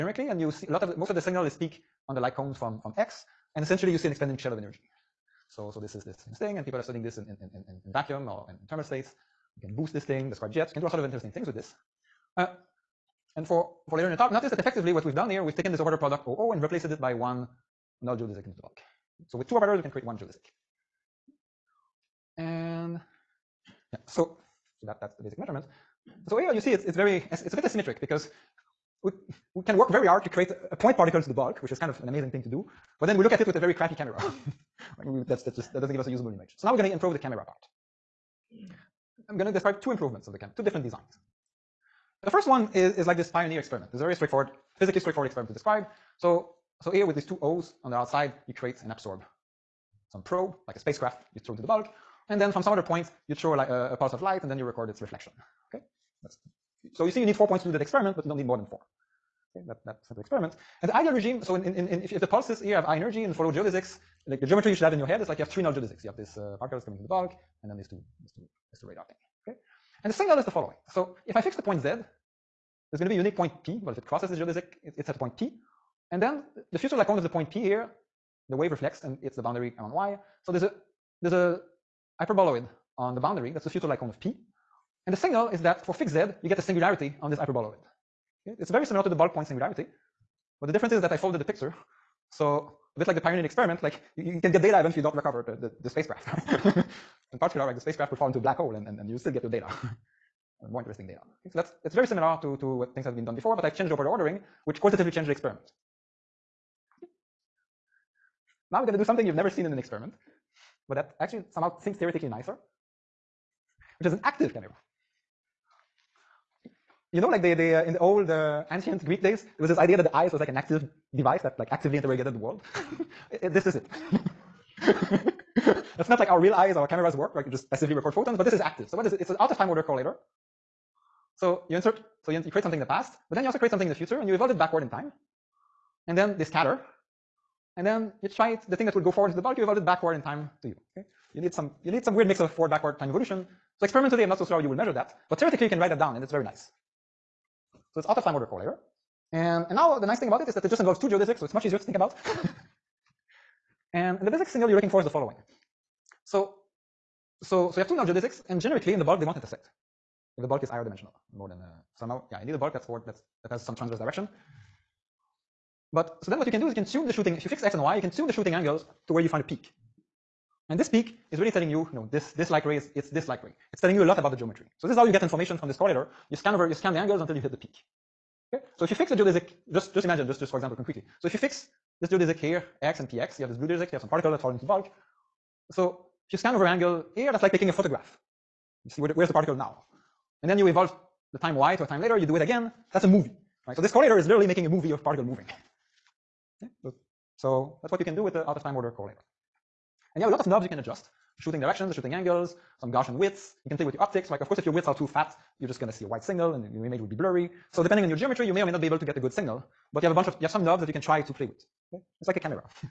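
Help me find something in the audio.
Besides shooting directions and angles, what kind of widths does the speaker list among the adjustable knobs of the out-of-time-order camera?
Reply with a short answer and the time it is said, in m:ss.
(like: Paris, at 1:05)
Gaussian widths, at 3:22.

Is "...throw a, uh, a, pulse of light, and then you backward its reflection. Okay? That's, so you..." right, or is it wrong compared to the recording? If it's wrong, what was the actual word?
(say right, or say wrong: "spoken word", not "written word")
wrong: "record", not "backward".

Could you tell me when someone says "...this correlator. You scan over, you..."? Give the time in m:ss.
2:55.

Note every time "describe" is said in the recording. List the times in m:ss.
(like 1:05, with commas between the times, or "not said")
0:10, 0:39, 0:45.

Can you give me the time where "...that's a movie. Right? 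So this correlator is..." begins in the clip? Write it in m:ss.
3:12.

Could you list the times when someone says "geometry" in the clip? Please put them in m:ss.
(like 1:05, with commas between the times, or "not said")
1:04, 2:54, 3:28.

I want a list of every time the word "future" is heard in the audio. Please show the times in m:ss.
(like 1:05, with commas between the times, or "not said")
1:16, 2:13.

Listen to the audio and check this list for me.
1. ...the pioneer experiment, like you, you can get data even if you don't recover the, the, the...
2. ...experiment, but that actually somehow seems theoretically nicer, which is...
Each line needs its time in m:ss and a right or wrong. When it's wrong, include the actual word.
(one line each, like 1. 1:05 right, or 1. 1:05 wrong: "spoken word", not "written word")
1. 1:33 right
2. 1:49 right.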